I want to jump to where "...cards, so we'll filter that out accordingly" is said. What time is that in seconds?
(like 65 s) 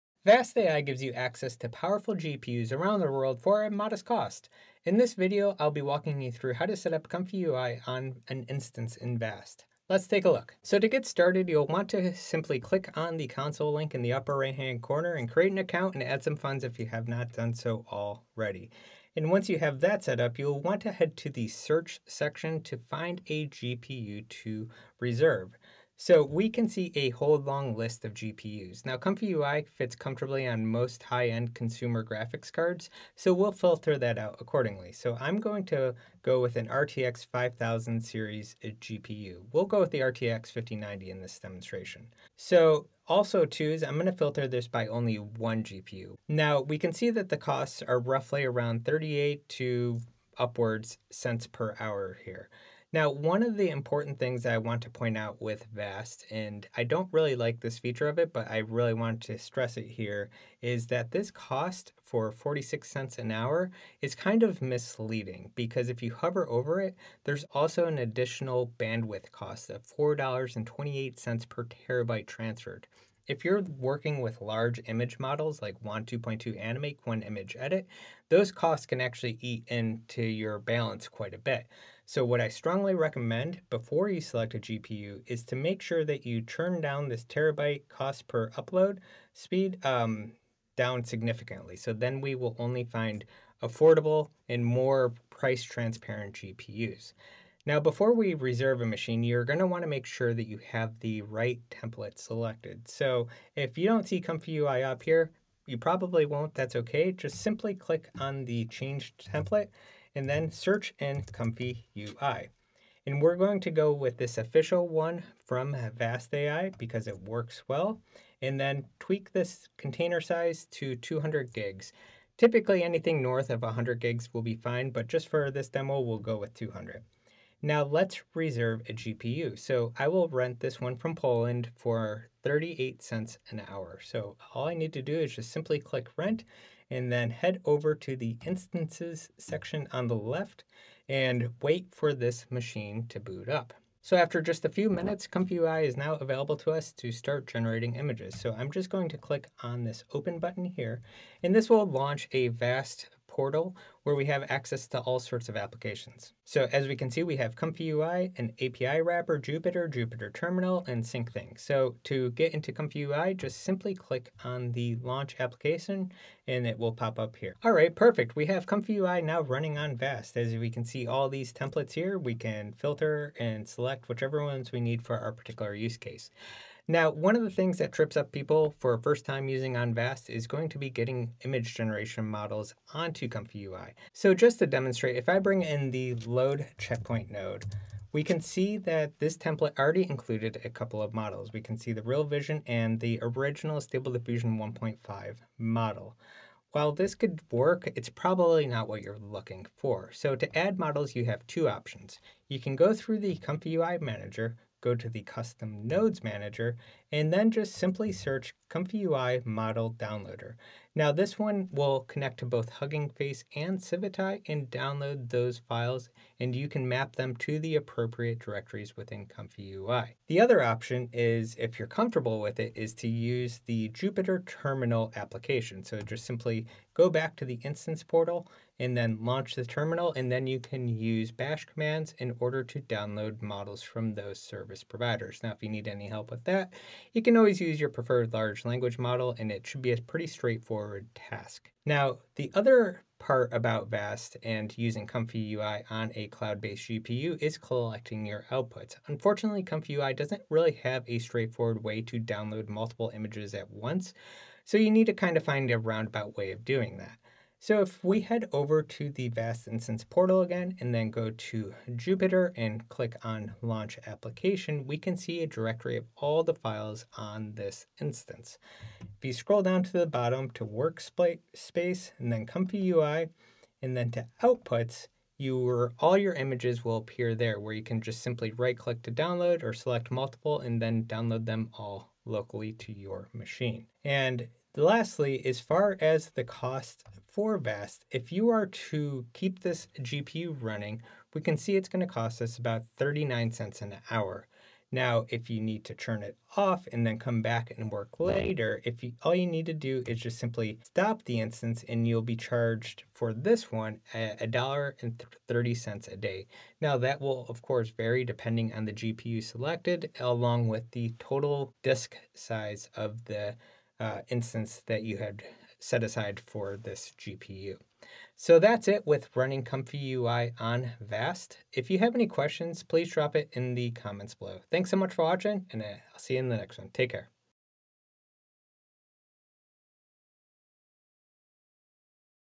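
32 s.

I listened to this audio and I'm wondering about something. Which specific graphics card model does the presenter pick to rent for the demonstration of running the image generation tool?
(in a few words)
RTX 5090.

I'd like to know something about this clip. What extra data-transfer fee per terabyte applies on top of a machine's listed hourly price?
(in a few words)
$4.28.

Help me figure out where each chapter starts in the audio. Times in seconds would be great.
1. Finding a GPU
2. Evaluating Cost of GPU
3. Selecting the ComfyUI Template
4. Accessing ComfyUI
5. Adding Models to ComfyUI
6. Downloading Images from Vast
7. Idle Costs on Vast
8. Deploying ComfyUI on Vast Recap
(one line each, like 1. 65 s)
1. 10 s
2. 46 s
3. 97 s
4. 143 s
5. 176 s
6. 241 s
7. 284 s
8. 318 s.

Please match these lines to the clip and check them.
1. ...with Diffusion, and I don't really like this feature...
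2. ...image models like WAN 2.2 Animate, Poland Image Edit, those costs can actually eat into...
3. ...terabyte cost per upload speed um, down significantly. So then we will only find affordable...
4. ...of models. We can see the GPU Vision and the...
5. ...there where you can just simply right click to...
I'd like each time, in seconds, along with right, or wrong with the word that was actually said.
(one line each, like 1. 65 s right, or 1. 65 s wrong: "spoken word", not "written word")
1. 55 s wrong: "Vast", not "Diffusion"
2. 74 s wrong: "Qwen", not "Poland"
3. 87 s right
4. 191 s wrong: "Real", not "GPU"
5. 277 s right.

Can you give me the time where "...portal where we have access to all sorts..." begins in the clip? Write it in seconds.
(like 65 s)
153 s.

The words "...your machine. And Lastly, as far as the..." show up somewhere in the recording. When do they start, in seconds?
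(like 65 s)
282 s.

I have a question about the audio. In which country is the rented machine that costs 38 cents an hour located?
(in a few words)
Poland.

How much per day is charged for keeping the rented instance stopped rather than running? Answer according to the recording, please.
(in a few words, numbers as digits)
$1.30.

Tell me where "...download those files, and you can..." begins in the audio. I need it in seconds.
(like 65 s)
214 s.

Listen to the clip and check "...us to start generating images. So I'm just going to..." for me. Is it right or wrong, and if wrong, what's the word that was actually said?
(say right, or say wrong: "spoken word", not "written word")
right.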